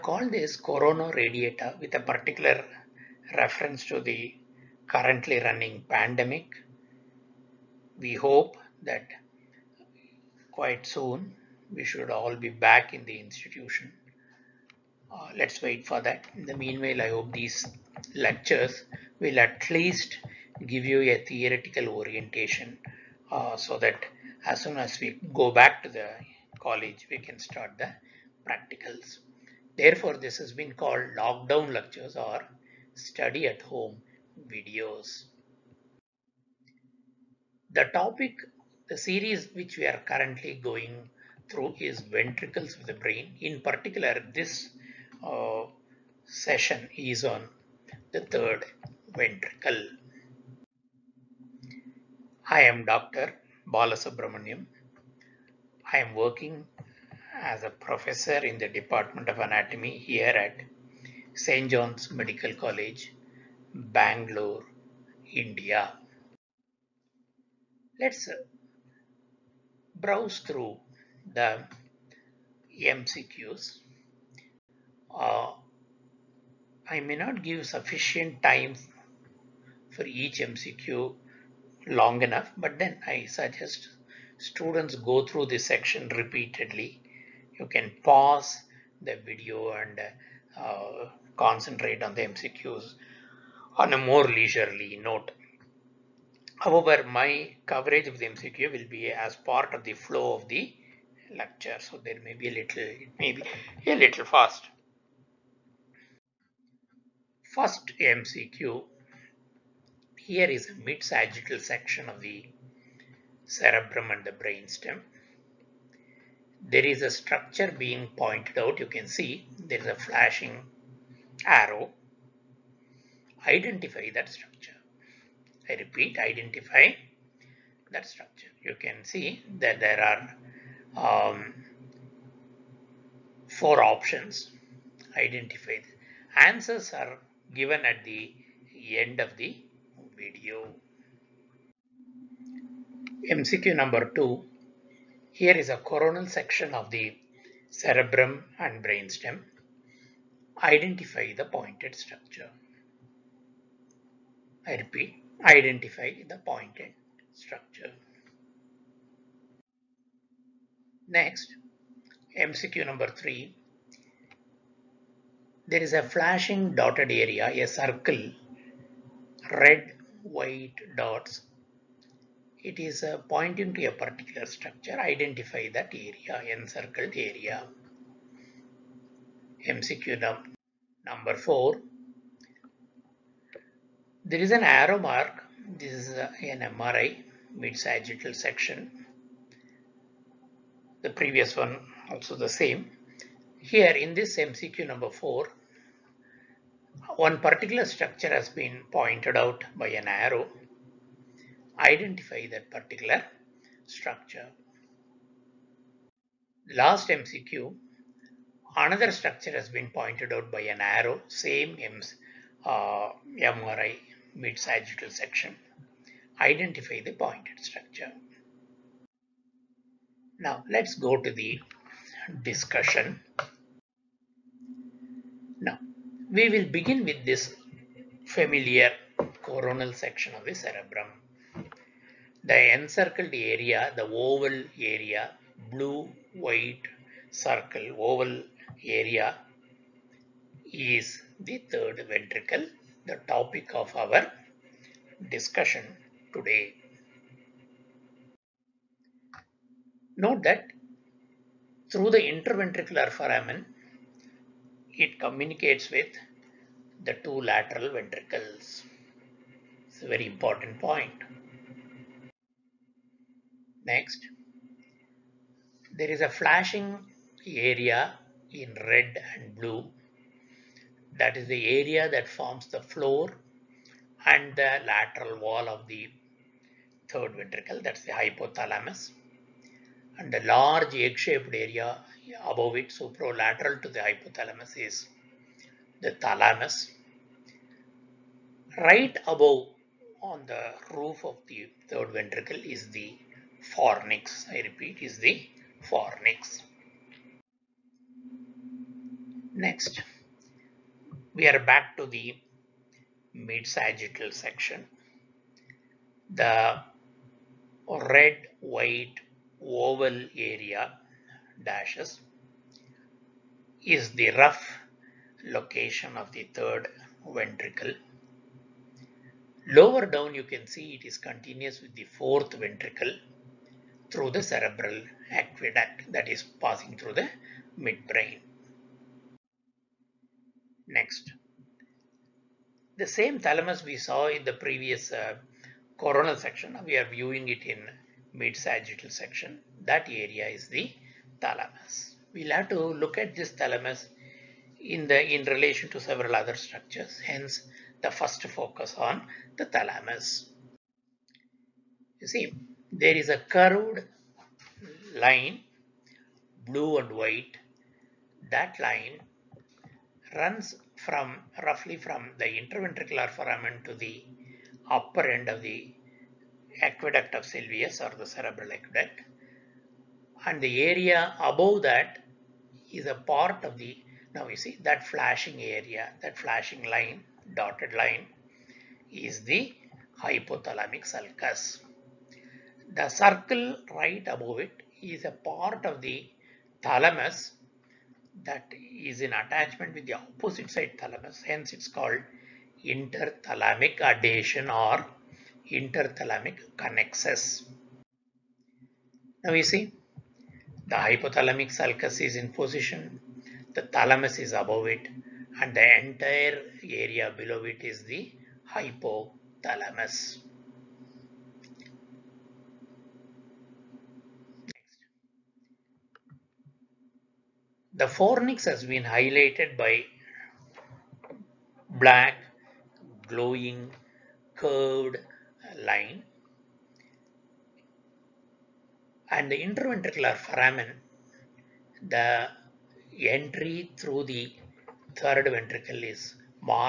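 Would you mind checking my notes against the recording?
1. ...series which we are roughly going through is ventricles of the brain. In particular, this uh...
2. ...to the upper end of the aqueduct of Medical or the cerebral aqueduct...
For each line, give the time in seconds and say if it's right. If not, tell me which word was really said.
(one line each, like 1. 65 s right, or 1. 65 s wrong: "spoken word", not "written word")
1. 38 s wrong: "currently", not "roughly"
2. 363 s wrong: "Sylvius", not "Medical".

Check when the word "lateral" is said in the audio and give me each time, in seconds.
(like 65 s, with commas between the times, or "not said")
257 s, 274 s.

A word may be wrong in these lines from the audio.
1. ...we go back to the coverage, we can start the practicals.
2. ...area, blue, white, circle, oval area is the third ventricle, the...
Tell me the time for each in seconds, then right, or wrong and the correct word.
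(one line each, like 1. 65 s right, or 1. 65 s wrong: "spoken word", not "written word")
1. 24 s wrong: "college", not "coverage"
2. 234 s right.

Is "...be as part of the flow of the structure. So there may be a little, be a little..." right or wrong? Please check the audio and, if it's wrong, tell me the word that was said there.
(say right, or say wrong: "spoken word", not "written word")
wrong: "lecture", not "structure".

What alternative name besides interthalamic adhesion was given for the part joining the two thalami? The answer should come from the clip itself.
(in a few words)
Interthalamic connexus.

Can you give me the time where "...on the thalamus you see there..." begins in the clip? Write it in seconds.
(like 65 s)
348 s.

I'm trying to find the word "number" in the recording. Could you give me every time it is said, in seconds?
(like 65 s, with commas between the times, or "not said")
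143 s, 162 s, 181 s, 194 s.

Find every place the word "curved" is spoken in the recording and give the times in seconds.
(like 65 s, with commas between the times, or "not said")
353 s, 424 s.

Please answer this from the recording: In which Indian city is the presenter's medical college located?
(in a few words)
Bangalore.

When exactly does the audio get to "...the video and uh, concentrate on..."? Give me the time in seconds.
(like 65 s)
89 s.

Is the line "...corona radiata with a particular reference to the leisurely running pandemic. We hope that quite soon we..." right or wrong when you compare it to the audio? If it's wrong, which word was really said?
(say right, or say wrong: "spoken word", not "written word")
wrong: "currently", not "leisurely".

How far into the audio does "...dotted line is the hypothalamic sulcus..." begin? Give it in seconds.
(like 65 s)
377 s.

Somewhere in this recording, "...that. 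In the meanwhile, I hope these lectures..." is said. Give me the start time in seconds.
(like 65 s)
16 s.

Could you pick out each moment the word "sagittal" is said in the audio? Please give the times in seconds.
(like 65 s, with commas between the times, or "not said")
110 s, 187 s, 214 s, 303 s, 338 s.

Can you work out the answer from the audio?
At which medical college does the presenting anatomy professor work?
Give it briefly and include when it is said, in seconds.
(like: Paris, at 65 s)
St. John's Medical College, at 61 s.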